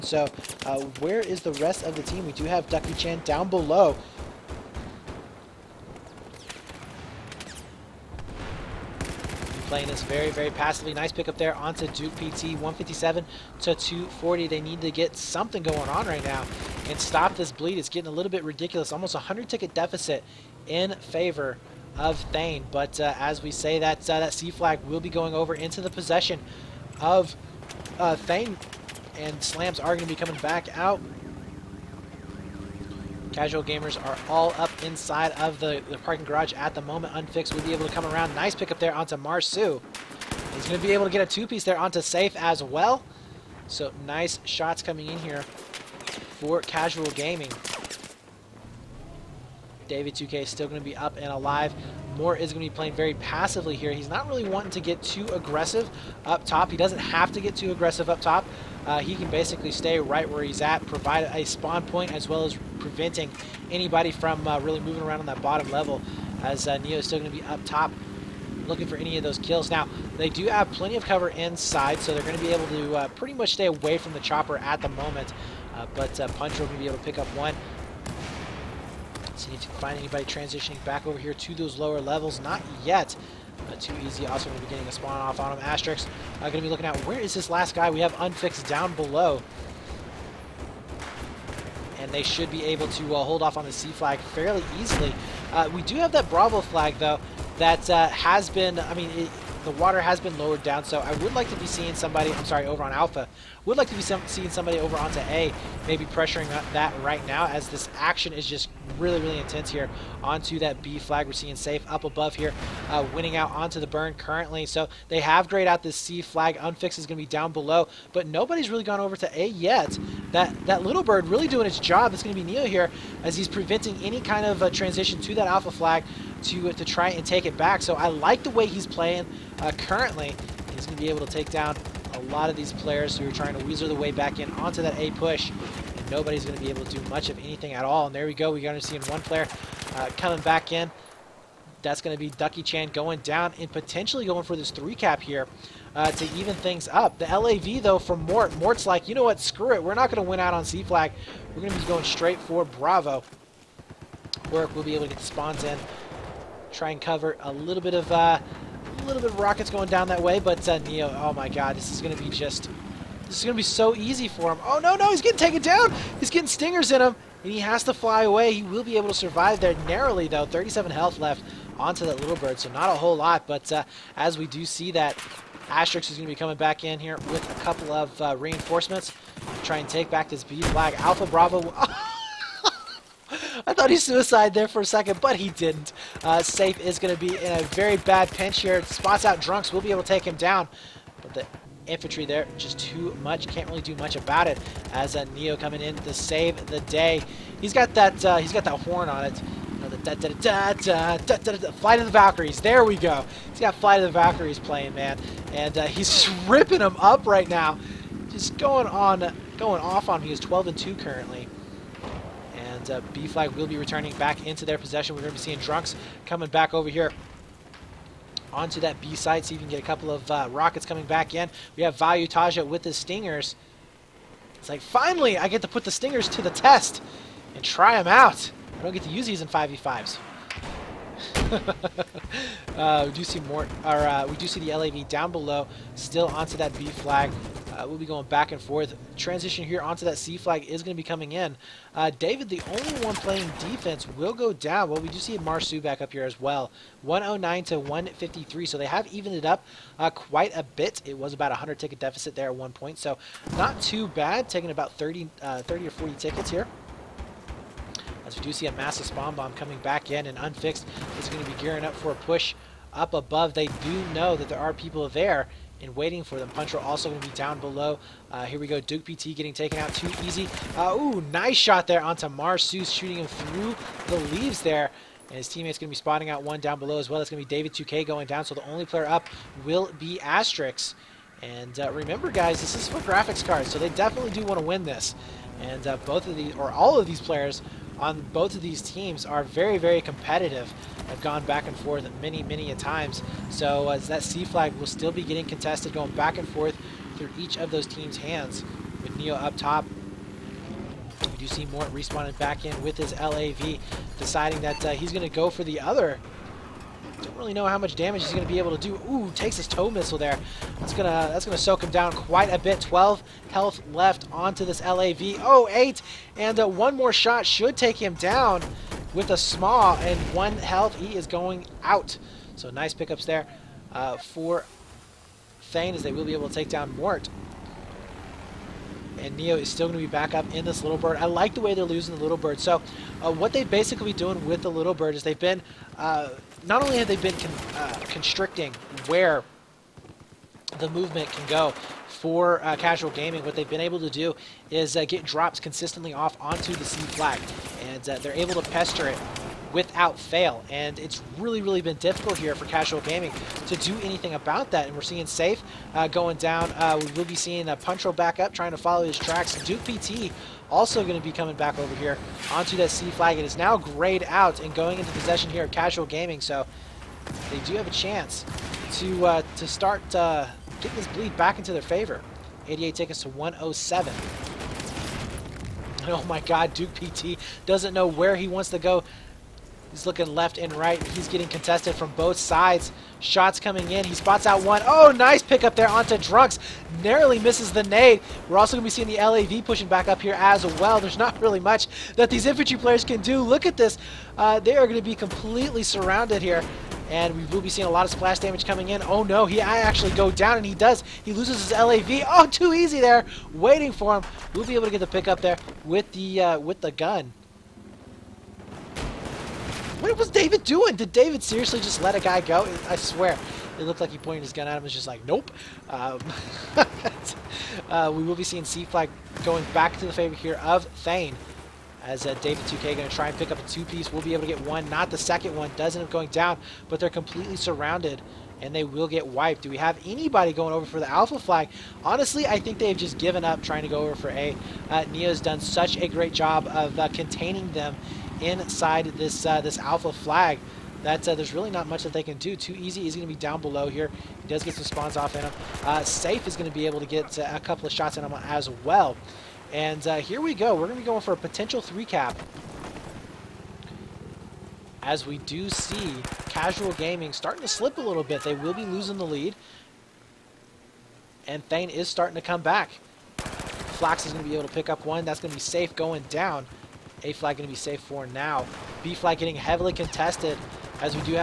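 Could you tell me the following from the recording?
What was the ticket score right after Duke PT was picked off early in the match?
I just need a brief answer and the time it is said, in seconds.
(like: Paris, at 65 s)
157 to 240, at 12 s.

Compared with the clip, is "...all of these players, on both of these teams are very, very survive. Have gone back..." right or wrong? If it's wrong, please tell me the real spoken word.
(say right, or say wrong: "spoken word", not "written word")
wrong: "competitive", not "survive".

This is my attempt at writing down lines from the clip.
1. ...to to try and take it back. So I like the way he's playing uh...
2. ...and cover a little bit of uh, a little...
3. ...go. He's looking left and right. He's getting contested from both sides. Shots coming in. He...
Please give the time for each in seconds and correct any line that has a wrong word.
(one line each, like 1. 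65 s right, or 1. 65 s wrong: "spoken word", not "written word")
1. 126 s right
2. 156 s right
3. 378 s right.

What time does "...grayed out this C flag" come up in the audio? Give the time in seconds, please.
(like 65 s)
115 s.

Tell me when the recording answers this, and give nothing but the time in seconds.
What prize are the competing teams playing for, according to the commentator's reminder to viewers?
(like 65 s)
282 s.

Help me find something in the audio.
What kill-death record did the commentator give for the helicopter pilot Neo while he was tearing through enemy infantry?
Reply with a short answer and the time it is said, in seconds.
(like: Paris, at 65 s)
12 and 2, at 210 s.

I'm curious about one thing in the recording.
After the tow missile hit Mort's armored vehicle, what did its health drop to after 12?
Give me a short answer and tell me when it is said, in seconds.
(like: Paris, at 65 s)
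8, at 315 s.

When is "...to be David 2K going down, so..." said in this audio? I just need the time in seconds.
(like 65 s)
277 s.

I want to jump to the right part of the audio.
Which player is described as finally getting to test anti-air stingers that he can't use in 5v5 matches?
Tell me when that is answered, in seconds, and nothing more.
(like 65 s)
221 s.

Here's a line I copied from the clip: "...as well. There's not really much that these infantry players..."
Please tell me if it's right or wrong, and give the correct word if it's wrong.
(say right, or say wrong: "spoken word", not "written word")
right.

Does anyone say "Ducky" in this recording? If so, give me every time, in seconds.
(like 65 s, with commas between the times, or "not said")
2 s, 142 s.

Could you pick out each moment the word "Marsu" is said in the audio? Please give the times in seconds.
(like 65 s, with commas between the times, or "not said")
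39 s, 245 s, 272 s.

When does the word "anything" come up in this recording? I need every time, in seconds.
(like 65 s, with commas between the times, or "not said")
137 s, 354 s.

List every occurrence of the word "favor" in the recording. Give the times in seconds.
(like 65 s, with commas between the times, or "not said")
21 s, 371 s, 420 s.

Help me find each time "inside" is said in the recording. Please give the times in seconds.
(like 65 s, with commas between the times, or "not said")
34 s, 71 s, 438 s.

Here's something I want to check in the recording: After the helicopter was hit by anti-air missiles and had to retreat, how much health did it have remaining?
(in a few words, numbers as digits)
37.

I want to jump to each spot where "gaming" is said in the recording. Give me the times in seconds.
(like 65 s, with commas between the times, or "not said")
47 s, 343 s, 353 s, 366 s, 456 s.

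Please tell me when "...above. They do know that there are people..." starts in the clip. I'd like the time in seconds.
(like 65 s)
263 s.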